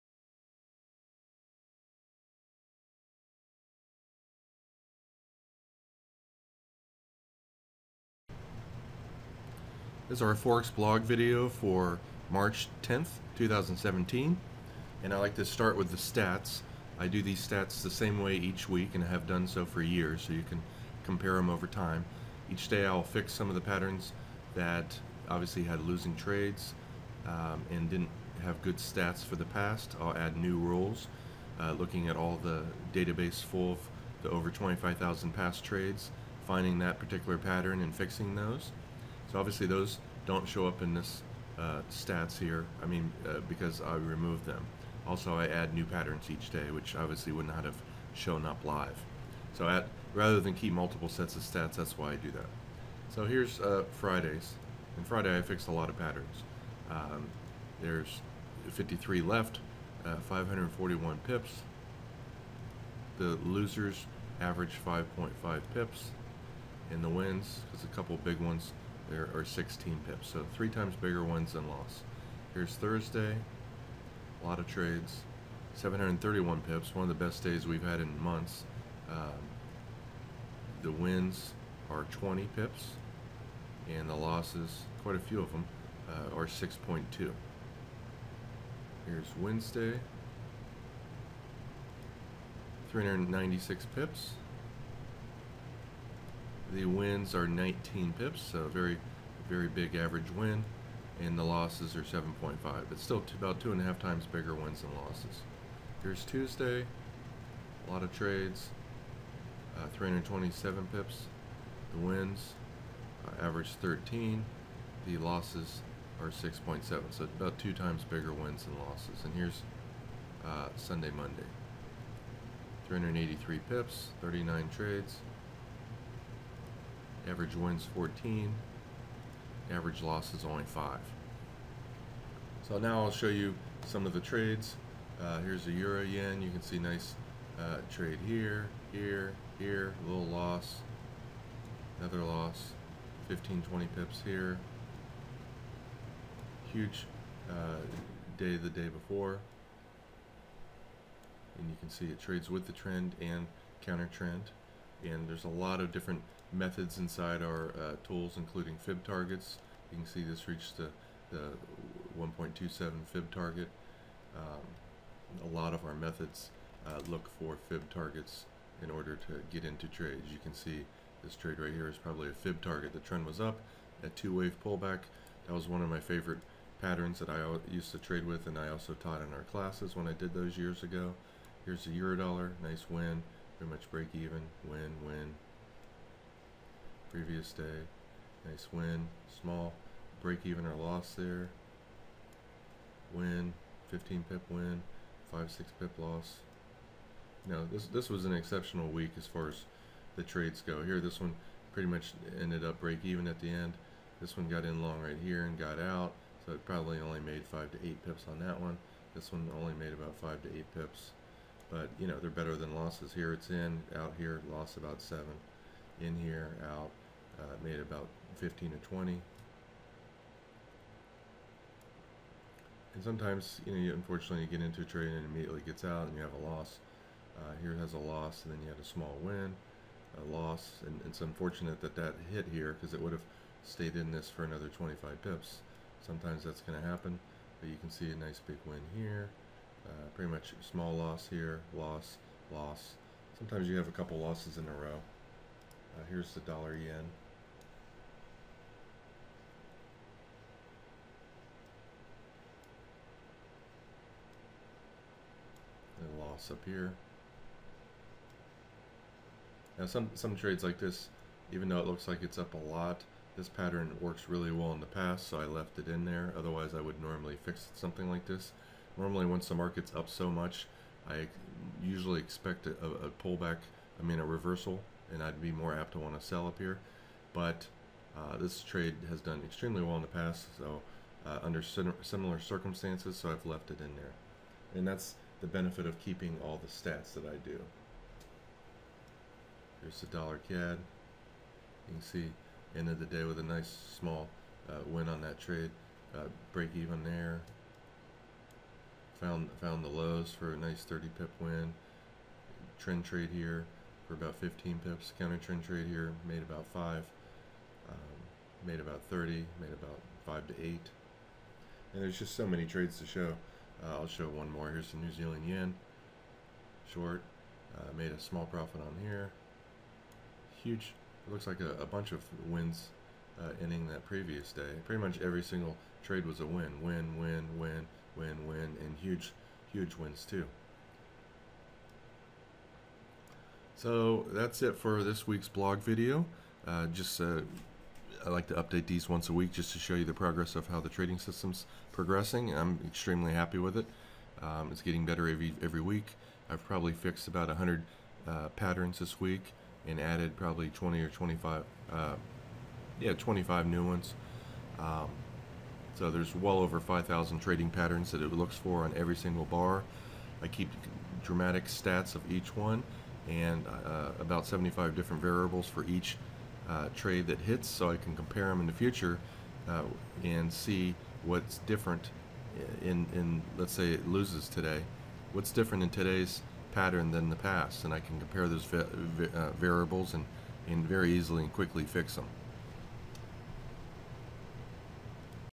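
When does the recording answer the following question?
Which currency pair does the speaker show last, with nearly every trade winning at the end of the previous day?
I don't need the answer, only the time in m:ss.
5:14.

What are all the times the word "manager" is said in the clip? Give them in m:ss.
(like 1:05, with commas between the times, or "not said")
not said.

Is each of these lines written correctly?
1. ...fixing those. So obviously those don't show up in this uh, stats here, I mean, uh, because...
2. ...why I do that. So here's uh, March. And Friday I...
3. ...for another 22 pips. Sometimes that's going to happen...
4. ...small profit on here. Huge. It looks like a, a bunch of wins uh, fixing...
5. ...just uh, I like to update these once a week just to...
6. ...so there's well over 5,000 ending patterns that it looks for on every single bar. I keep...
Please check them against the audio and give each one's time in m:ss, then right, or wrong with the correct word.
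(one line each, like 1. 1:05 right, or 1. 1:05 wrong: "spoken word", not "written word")
1. 0:37 right
2. 0:51 wrong: "Fridays", not "March"
3. 3:54 wrong: "25", not "22"
4. 5:18 wrong: "ending", not "fixing"
5. 5:36 right
6. 5:55 wrong: "trading", not "ending".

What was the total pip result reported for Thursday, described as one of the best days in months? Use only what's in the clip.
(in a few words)
731 pips.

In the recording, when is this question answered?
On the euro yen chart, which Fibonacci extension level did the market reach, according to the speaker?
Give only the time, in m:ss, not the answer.
2:42.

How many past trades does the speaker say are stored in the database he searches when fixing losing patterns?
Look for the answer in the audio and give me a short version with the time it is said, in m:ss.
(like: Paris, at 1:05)
over 25,000, at 0:34.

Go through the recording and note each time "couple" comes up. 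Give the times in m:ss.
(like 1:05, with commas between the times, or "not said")
1:07, 4:03.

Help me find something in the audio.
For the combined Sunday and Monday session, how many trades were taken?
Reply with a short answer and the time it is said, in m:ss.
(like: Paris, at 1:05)
39, at 2:04.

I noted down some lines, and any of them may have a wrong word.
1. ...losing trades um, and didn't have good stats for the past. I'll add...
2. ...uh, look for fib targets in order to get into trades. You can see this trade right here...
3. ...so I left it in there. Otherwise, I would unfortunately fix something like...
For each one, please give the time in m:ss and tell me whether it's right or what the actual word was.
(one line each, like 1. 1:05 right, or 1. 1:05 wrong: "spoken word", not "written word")
1. 0:25 right
2. 2:46 right
3. 4:25 wrong: "normally", not "unfortunately".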